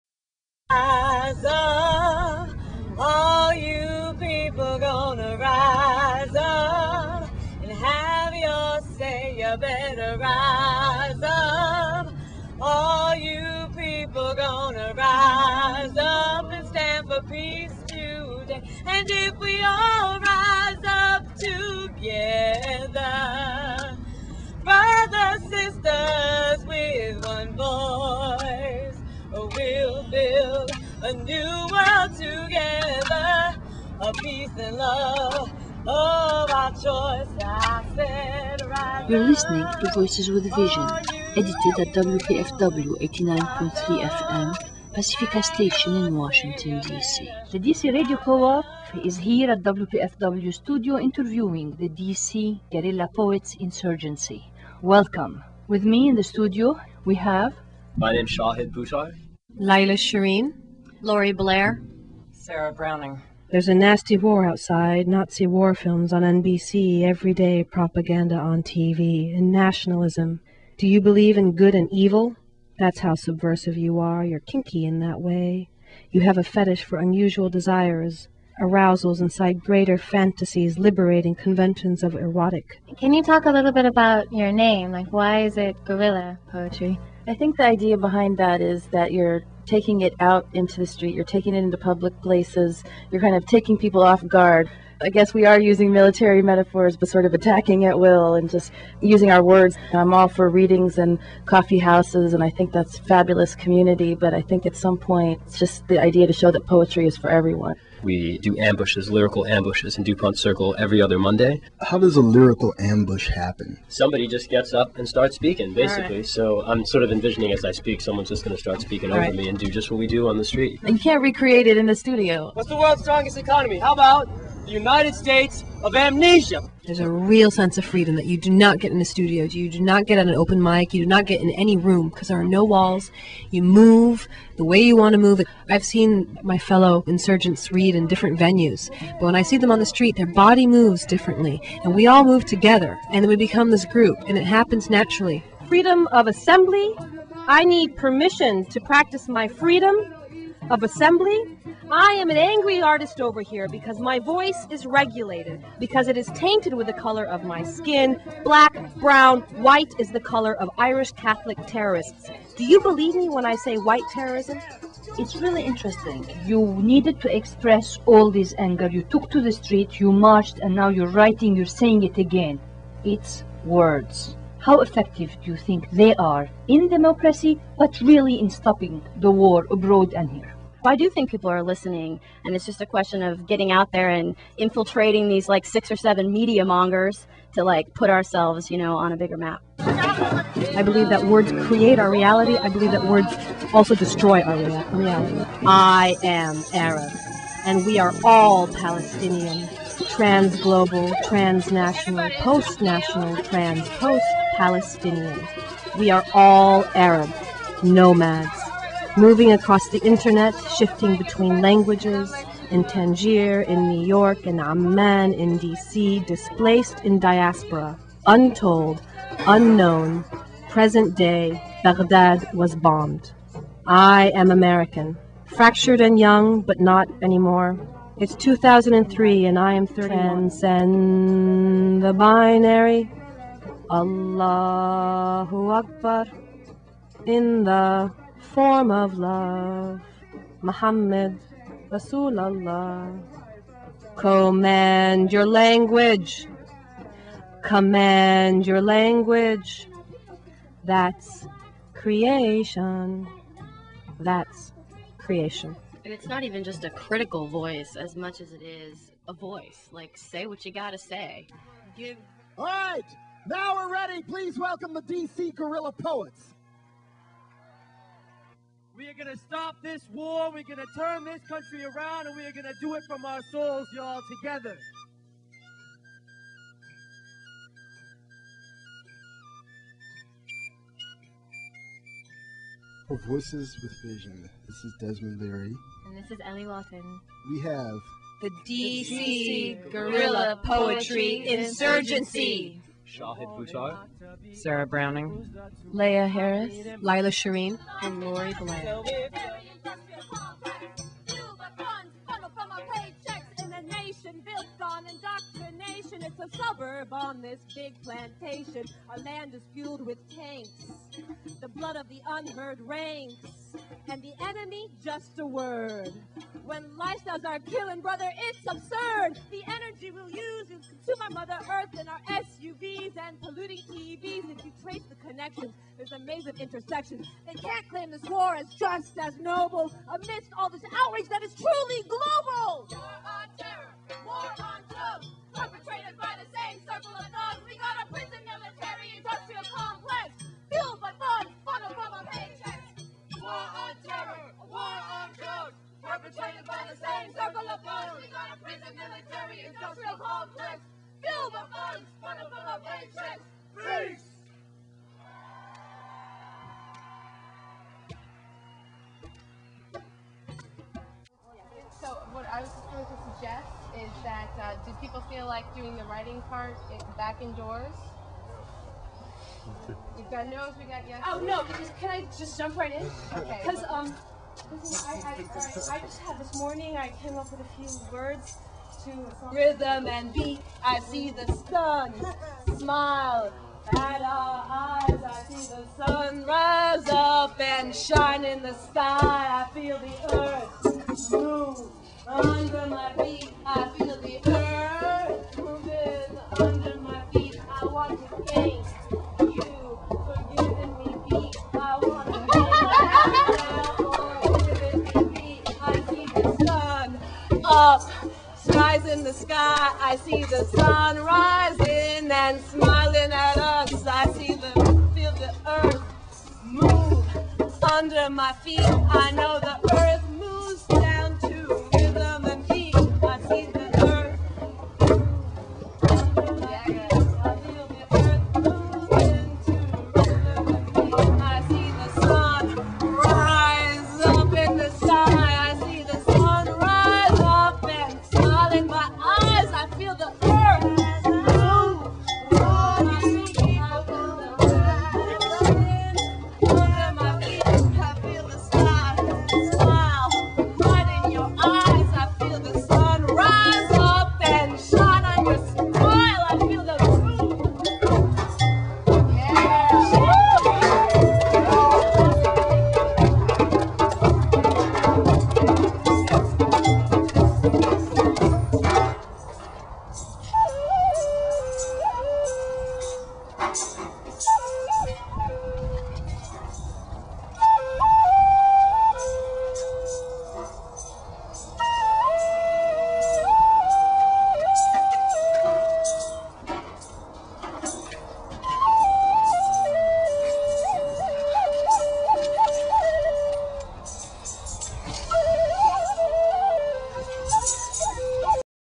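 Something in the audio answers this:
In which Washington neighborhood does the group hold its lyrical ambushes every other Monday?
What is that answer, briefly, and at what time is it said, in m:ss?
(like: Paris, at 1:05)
DuPont Circle, at 1:50.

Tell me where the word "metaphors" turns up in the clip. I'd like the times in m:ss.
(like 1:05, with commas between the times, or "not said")
1:36.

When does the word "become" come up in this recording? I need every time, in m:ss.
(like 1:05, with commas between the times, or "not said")
2:23.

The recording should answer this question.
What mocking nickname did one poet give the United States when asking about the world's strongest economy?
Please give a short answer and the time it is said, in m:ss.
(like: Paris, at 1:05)
United States of Amnesia, at 2:04.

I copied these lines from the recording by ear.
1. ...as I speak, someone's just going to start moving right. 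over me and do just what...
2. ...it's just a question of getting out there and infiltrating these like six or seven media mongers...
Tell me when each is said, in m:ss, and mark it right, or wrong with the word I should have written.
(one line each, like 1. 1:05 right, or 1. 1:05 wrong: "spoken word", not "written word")
1. 1:57 wrong: "speaking", not "moving"
2. 3:02 right.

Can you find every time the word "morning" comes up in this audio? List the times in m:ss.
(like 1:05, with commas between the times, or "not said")
6:16.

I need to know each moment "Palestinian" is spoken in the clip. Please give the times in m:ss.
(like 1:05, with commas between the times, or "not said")
3:18, 3:24.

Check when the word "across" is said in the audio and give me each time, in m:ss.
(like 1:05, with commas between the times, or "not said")
3:29.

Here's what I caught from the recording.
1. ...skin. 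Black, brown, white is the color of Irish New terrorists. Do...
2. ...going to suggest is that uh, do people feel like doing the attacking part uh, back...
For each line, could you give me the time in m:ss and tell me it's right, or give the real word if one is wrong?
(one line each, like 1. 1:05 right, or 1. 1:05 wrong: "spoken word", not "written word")
1. 2:37 wrong: "Catholic", not "New"
2. 6:02 wrong: "writing", not "attacking".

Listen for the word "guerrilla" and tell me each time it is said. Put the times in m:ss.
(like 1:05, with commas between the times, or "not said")
0:52, 1:25, 4:25, 4:49.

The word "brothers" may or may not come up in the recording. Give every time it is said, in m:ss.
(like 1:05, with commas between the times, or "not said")
0:24, 5:18.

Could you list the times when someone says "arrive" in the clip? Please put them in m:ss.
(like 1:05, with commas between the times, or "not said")
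not said.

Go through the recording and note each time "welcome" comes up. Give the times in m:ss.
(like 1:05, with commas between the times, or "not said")
0:54, 4:24.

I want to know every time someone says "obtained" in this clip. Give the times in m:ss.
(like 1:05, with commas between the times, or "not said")
not said.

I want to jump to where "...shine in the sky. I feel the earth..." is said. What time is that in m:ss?
6:27.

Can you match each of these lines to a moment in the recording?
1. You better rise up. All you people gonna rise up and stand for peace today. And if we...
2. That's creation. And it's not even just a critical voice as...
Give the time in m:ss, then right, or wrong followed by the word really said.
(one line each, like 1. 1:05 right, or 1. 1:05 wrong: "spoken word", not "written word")
1. 0:09 right
2. 4:14 right.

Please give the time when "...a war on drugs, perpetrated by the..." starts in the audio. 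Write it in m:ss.
5:44.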